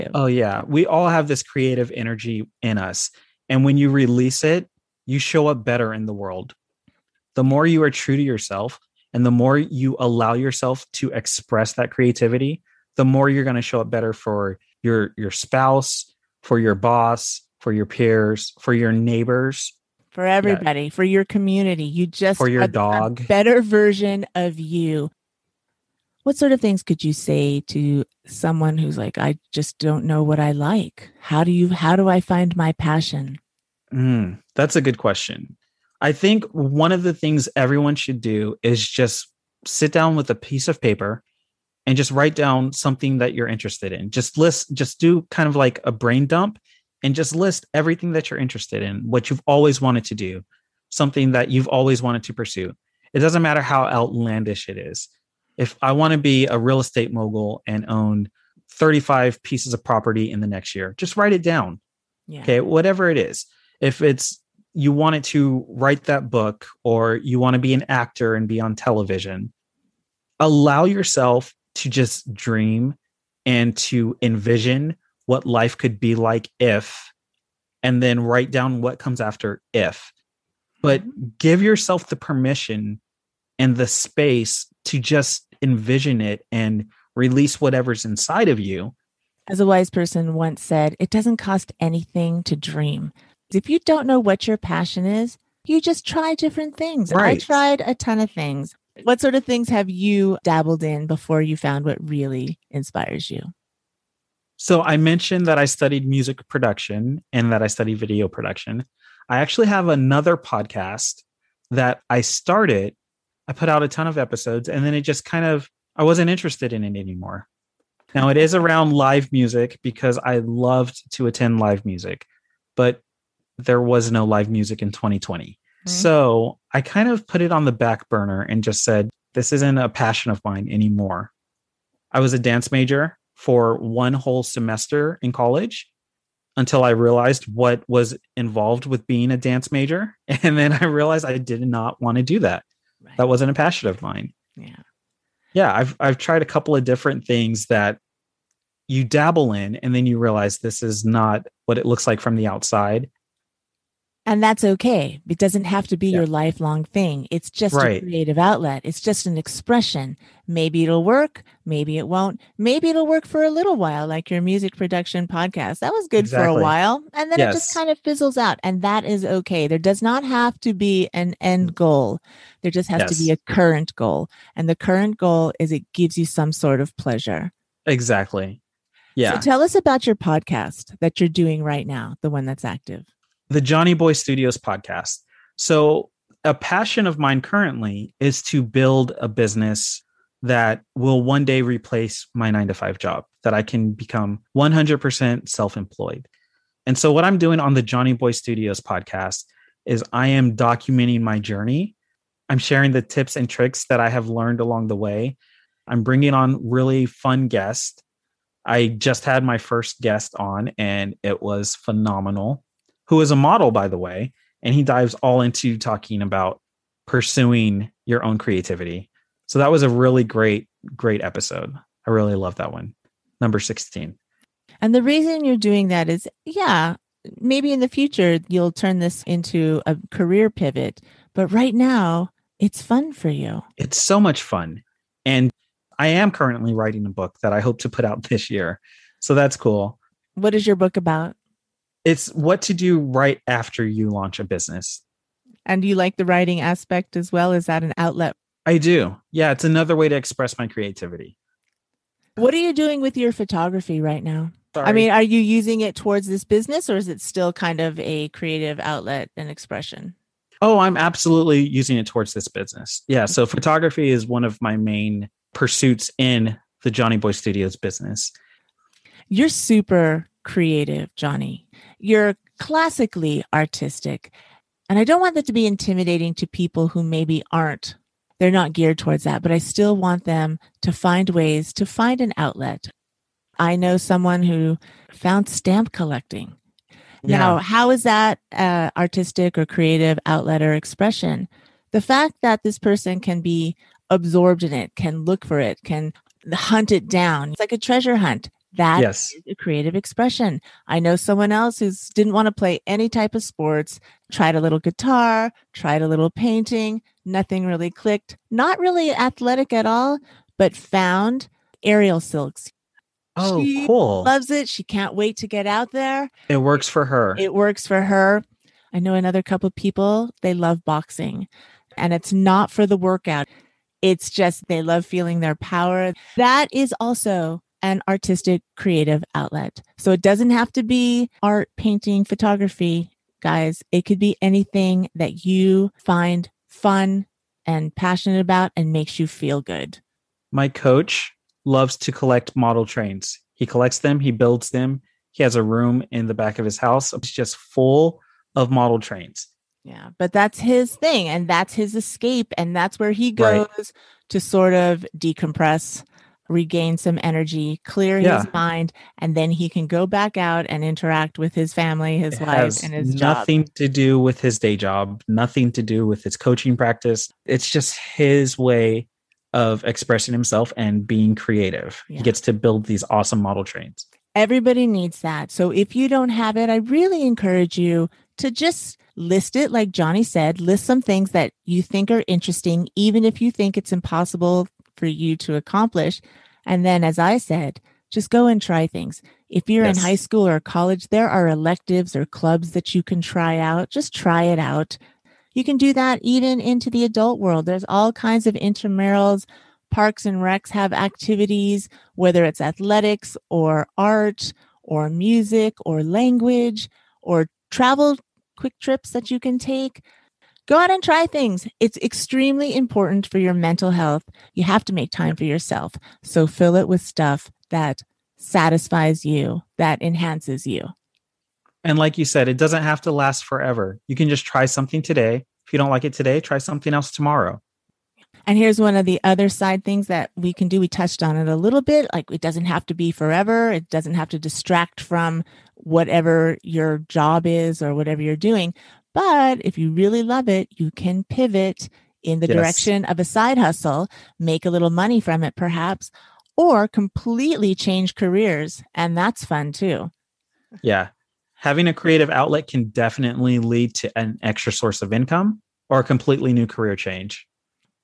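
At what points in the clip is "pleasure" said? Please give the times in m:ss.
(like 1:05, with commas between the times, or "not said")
2:56.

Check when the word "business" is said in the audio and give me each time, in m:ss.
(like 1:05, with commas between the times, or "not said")
3:09, 4:04, 4:16, 4:22, 4:27.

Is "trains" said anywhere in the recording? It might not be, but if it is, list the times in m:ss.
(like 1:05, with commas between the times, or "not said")
5:42, 5:48, 6:13.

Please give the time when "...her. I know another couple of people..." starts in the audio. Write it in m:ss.
5:17.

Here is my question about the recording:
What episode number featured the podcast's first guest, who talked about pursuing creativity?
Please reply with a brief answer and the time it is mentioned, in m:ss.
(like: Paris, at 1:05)
16, at 3:43.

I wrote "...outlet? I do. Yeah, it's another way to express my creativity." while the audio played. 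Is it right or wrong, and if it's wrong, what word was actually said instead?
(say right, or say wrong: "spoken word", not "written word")
right.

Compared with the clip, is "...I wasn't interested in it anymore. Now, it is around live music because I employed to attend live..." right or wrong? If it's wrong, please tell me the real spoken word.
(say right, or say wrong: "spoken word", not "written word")
wrong: "loved", not "employed".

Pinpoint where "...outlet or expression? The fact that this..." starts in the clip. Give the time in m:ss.
4:50.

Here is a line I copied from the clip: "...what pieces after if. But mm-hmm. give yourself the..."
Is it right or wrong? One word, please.
wrong.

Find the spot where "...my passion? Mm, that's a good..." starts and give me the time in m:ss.
0:32.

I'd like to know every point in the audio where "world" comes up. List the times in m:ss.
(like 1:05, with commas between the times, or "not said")
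0:06, 6:37.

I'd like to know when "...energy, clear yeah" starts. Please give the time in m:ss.
5:57.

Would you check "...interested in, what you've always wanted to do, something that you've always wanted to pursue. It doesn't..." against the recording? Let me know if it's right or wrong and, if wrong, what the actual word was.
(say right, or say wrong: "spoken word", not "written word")
right.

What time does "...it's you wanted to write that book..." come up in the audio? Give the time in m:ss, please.
1:03.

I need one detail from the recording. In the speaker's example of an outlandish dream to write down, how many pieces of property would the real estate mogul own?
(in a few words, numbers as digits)
35.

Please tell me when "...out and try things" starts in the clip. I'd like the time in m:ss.
6:50.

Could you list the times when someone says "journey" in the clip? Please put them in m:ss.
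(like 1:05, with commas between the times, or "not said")
3:21.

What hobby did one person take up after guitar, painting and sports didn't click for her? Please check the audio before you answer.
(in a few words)
Aerial silks.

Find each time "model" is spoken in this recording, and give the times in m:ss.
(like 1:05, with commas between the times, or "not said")
3:33, 5:42, 5:48, 6:13.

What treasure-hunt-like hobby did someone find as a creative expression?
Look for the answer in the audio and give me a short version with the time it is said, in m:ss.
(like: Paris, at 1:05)
Stamp collecting, at 4:45.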